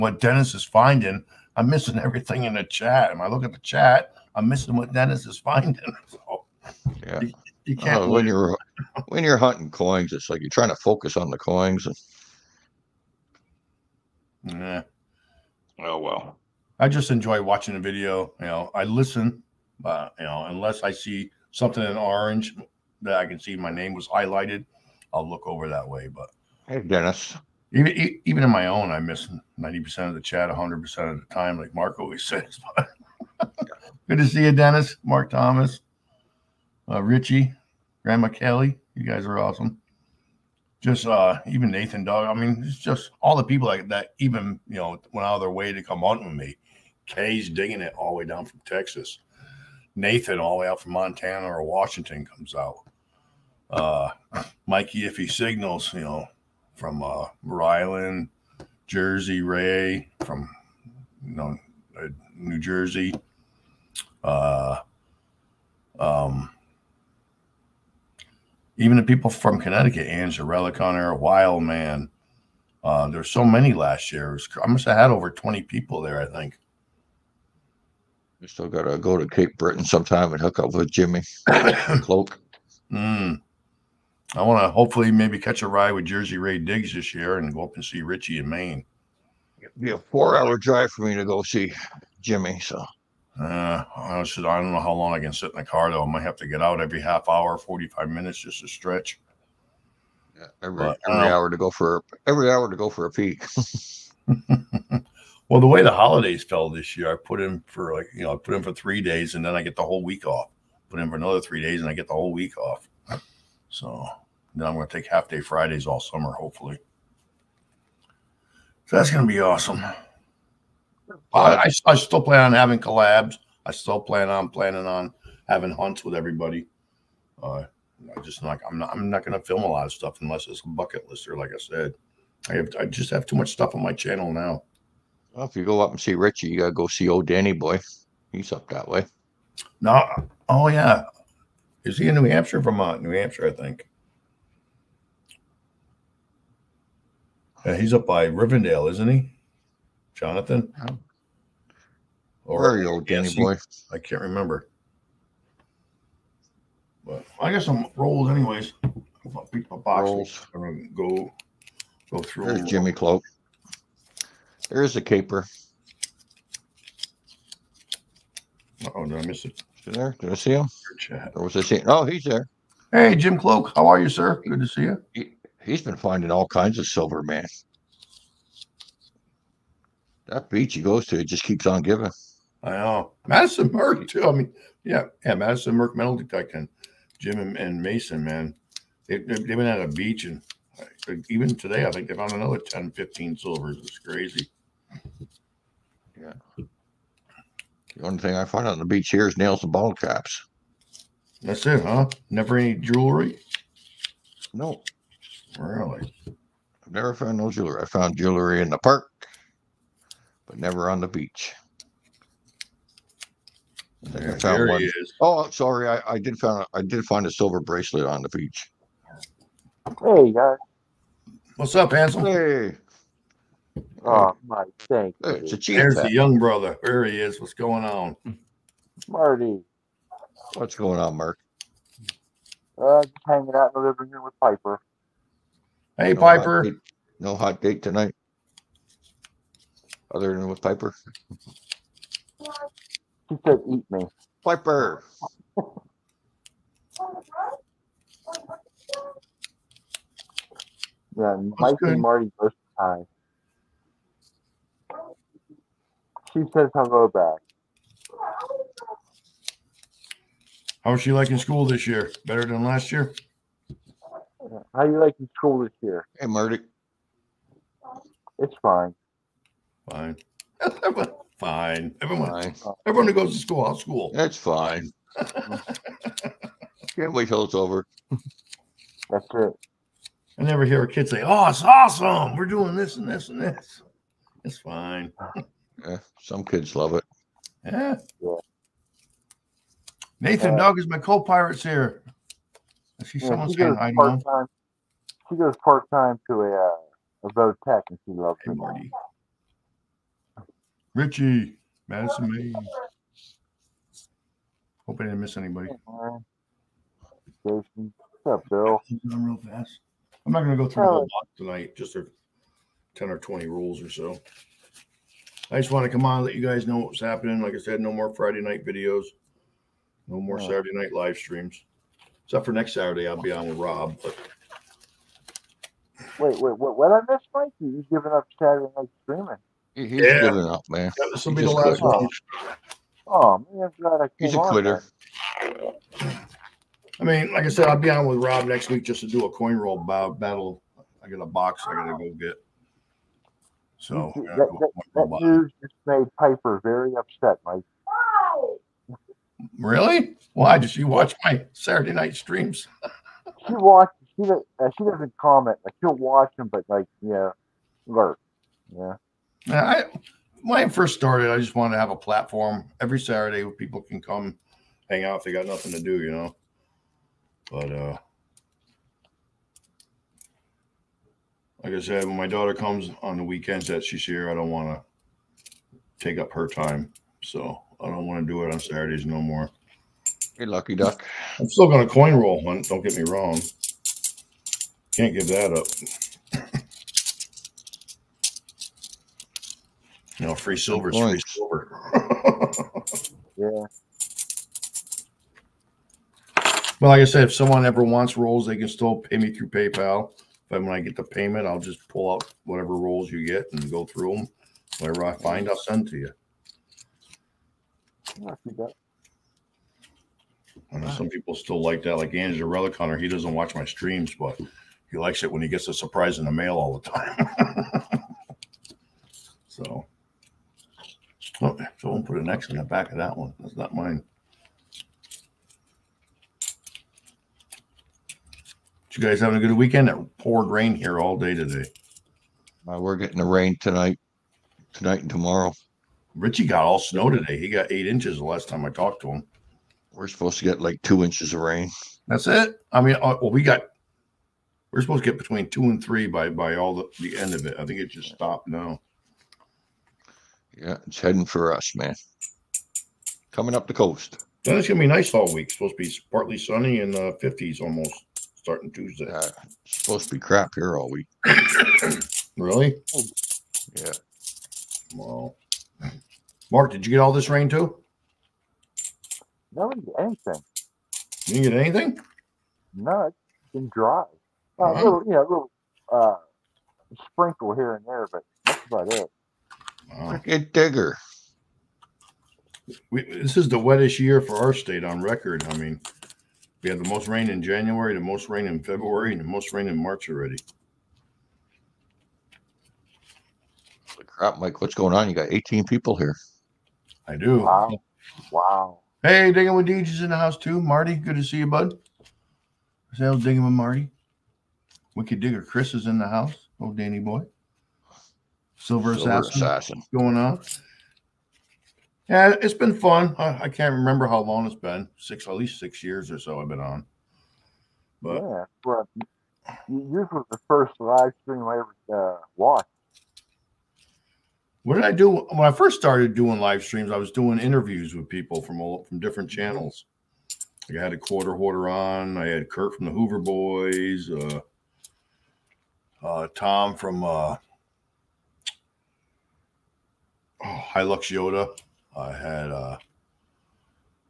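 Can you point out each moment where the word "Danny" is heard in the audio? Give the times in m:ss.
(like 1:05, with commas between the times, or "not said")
2:17, 2:33, 8:26.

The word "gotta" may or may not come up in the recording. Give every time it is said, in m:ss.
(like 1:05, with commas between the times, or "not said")
1:18, 2:16, 5:41.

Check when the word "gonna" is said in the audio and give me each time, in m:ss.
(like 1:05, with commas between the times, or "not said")
2:40, 7:34.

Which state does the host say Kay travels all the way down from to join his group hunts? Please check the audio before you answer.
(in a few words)
Texas.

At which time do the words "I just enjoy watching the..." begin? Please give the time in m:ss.
0:16.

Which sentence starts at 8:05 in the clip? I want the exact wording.
I mean, we had the most rain in January, the most rain in February, and the most rain in March already.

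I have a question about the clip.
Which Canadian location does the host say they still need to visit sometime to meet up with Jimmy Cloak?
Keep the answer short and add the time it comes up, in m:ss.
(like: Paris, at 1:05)
Cape Breton, at 1:19.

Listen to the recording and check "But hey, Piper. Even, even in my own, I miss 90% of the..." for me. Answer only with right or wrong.
wrong.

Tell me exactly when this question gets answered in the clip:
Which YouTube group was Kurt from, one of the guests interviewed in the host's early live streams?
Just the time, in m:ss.
8:52.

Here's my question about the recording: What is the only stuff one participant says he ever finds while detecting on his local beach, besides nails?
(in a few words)
Ball caps.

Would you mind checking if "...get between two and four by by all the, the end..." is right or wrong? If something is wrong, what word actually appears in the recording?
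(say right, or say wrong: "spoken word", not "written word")
wrong: "three", not "four".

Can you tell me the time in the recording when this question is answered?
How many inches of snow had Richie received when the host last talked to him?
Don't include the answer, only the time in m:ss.
7:17.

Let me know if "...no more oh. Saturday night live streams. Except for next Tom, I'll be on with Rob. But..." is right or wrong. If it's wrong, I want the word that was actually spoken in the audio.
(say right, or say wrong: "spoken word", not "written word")
wrong: "Saturday", not "Tom".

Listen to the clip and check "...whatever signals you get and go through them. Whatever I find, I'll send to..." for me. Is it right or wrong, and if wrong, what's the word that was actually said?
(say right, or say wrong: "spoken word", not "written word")
wrong: "rolls", not "signals".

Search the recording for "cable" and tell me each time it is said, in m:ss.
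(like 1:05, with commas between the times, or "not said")
not said.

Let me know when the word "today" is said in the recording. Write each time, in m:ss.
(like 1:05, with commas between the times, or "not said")
3:11, 7:11, 7:17.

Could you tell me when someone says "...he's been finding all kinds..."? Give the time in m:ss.
2:55.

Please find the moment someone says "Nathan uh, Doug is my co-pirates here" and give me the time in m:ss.
4:50.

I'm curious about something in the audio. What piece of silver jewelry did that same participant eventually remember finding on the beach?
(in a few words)
Silver bracelet.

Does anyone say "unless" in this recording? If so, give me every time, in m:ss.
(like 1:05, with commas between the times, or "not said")
0:20, 2:10.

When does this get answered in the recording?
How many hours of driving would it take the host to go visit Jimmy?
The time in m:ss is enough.
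1:29.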